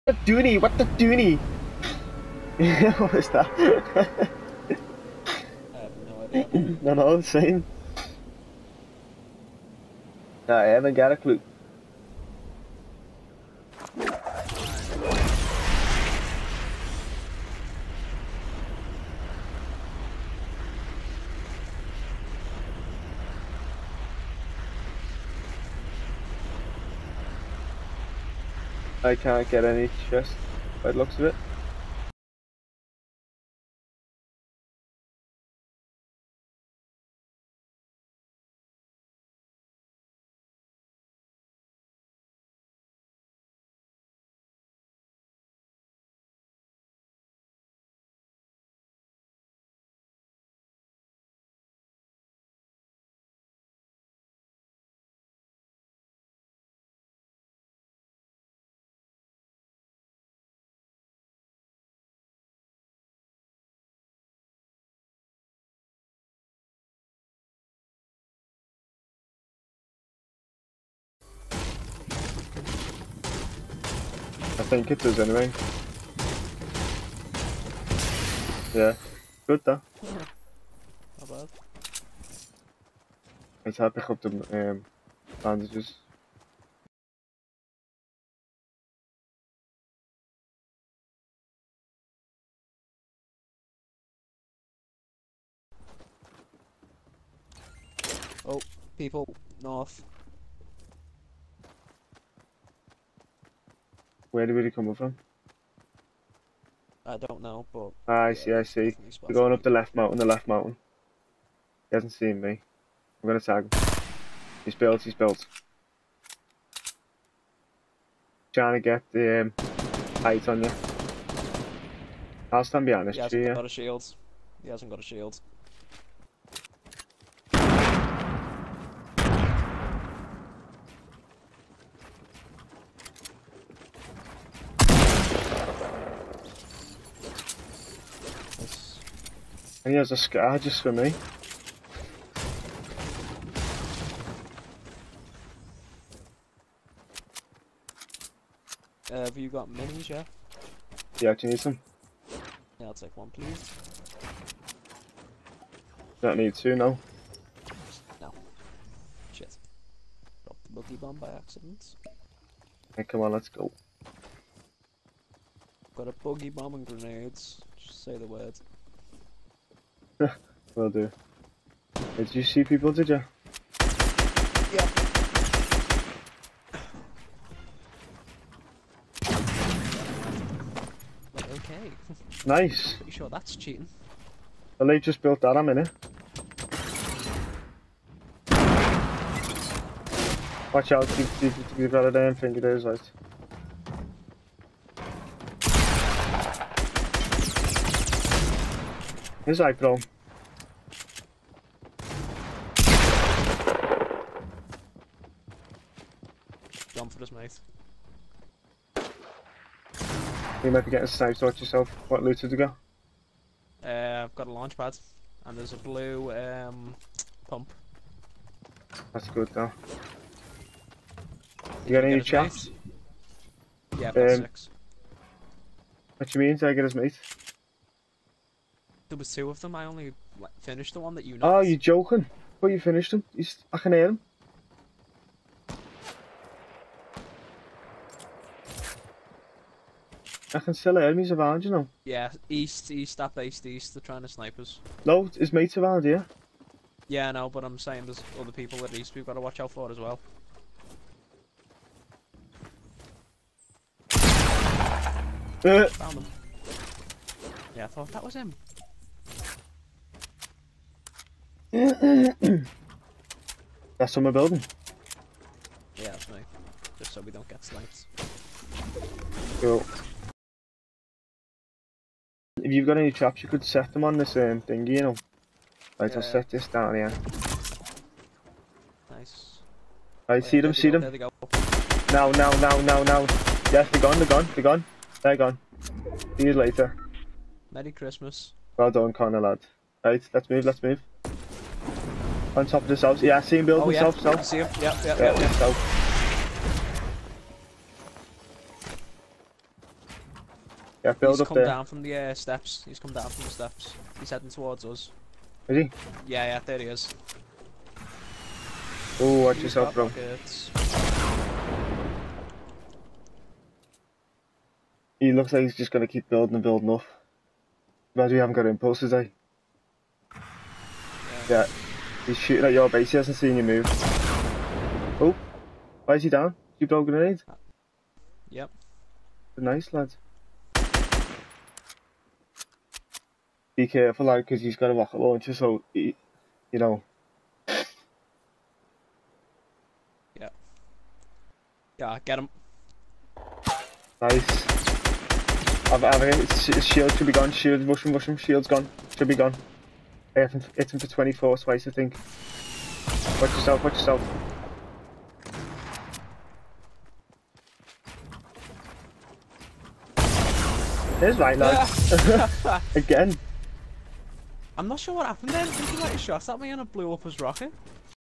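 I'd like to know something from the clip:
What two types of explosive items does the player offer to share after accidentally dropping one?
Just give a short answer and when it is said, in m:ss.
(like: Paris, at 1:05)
Boogie bomb and grenades, at 2:46.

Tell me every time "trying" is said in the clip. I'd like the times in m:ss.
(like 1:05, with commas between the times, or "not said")
1:58, 4:03.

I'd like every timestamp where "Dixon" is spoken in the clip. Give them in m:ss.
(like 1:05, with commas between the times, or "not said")
not said.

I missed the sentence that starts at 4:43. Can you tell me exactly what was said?
Yes, they're gone, they're gone, they're gone.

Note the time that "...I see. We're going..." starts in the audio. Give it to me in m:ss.
1:48.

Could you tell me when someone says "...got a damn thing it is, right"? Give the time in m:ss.
3:11.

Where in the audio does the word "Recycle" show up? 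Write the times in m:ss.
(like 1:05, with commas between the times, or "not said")
3:19.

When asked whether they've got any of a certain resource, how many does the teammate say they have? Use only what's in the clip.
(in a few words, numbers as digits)
6.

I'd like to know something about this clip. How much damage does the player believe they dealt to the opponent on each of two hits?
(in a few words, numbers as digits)
24.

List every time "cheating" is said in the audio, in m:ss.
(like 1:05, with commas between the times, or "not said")
3:03.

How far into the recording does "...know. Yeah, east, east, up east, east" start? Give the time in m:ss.
4:01.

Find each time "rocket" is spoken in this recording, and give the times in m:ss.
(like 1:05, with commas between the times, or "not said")
5:34, 6:07.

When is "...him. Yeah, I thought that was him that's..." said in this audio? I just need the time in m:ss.
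4:16.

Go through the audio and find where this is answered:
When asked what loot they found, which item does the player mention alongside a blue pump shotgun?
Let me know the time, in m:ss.
3:34.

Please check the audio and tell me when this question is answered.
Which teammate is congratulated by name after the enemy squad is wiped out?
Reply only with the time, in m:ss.
4:49.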